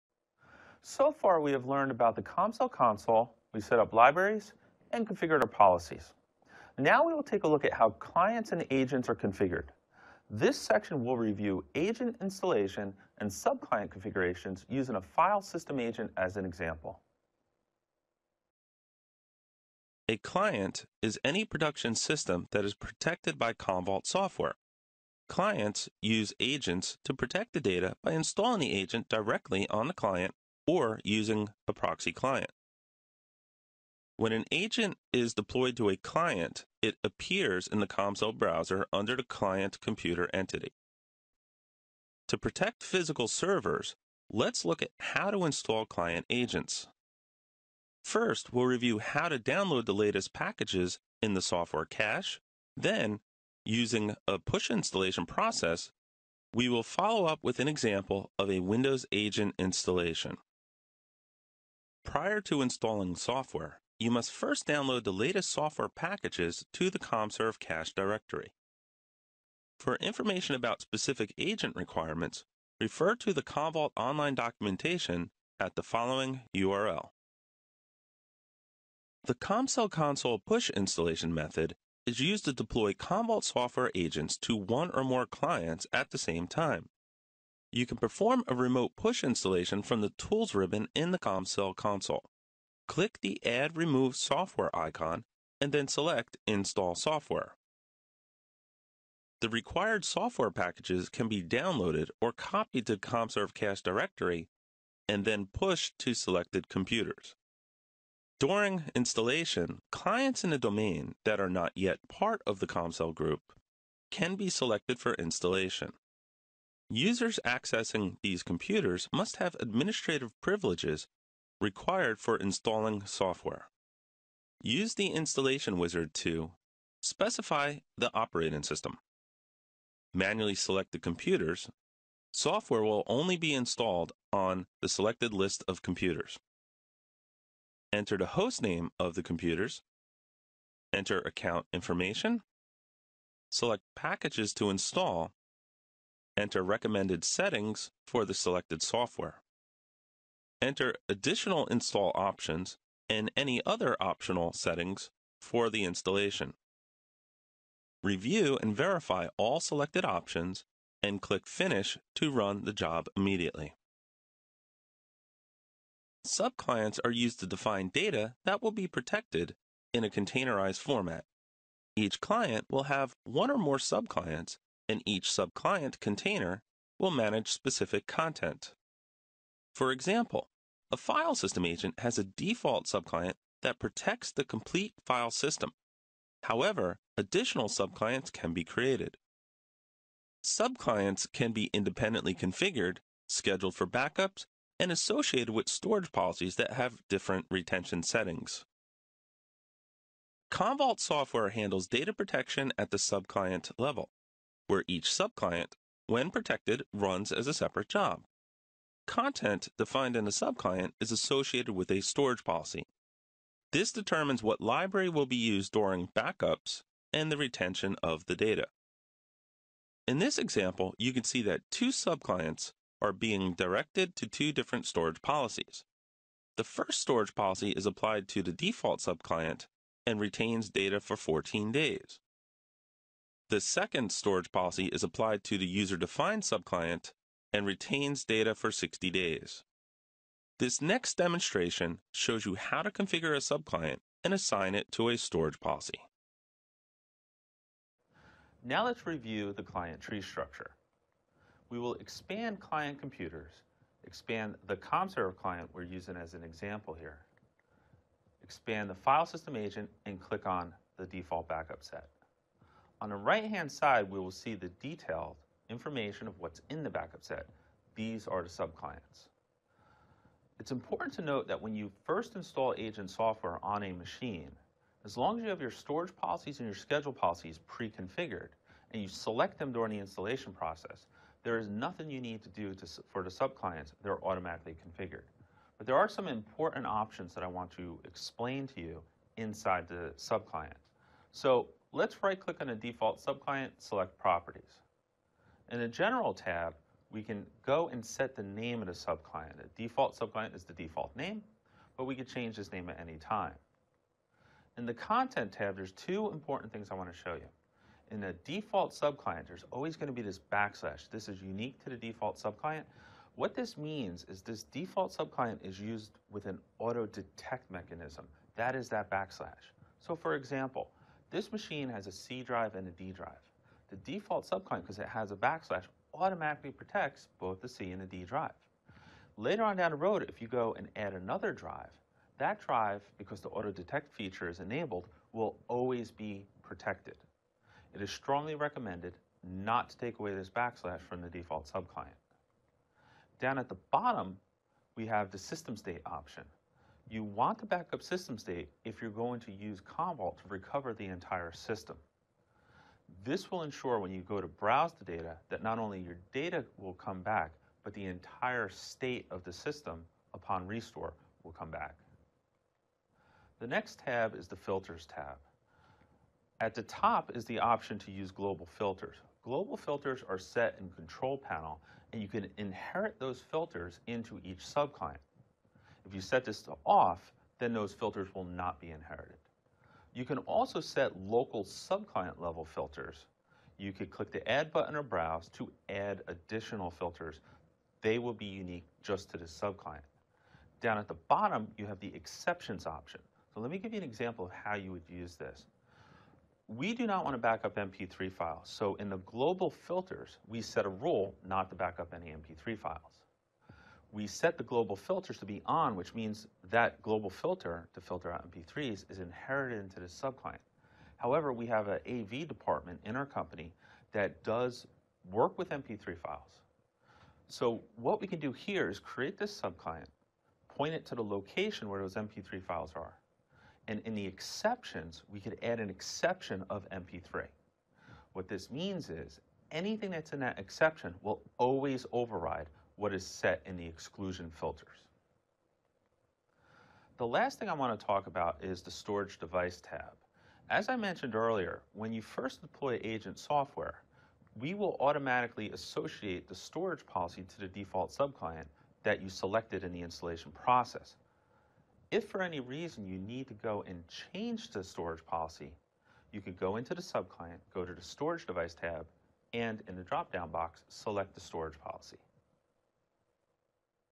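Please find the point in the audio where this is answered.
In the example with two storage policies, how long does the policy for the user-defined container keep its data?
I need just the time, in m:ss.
3:58.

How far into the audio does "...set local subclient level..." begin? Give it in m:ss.
6:20.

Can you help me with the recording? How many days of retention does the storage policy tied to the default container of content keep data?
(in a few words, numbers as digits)
14.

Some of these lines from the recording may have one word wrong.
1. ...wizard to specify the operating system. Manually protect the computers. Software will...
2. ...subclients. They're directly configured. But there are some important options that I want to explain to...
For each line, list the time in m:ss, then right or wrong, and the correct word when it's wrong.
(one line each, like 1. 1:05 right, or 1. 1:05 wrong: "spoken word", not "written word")
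1. 2:05 wrong: "select", not "protect"
2. 4:43 wrong: "automatically", not "directly".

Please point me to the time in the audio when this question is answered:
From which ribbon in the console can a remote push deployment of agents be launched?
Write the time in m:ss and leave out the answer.
1:30.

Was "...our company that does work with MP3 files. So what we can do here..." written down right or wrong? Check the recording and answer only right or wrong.
right.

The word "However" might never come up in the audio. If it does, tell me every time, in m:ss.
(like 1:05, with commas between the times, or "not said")
3:06, 6:51.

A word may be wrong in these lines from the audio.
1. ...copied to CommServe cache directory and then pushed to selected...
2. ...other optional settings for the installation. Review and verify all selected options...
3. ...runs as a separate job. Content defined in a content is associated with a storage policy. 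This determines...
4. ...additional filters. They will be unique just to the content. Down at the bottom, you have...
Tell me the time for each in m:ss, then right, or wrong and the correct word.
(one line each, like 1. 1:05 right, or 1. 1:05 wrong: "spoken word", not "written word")
1. 1:42 right
2. 2:33 right
3. 3:26 wrong: "subclient", not "content"
4. 6:26 wrong: "subclient", not "content".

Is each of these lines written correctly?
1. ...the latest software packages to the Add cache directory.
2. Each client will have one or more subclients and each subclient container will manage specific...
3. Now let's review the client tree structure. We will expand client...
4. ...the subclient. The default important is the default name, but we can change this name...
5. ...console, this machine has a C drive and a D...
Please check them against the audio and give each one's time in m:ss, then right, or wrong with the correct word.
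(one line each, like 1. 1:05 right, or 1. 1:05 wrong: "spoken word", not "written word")
1. 1:05 wrong: "CommServe", not "Add"
2. 2:51 right
3. 4:08 right
4. 4:58 wrong: "subclient", not "important"
5. 5:20 wrong: "example", not "console".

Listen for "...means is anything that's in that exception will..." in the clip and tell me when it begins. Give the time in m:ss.
7:08.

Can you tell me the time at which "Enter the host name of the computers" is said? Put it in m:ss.
2:17.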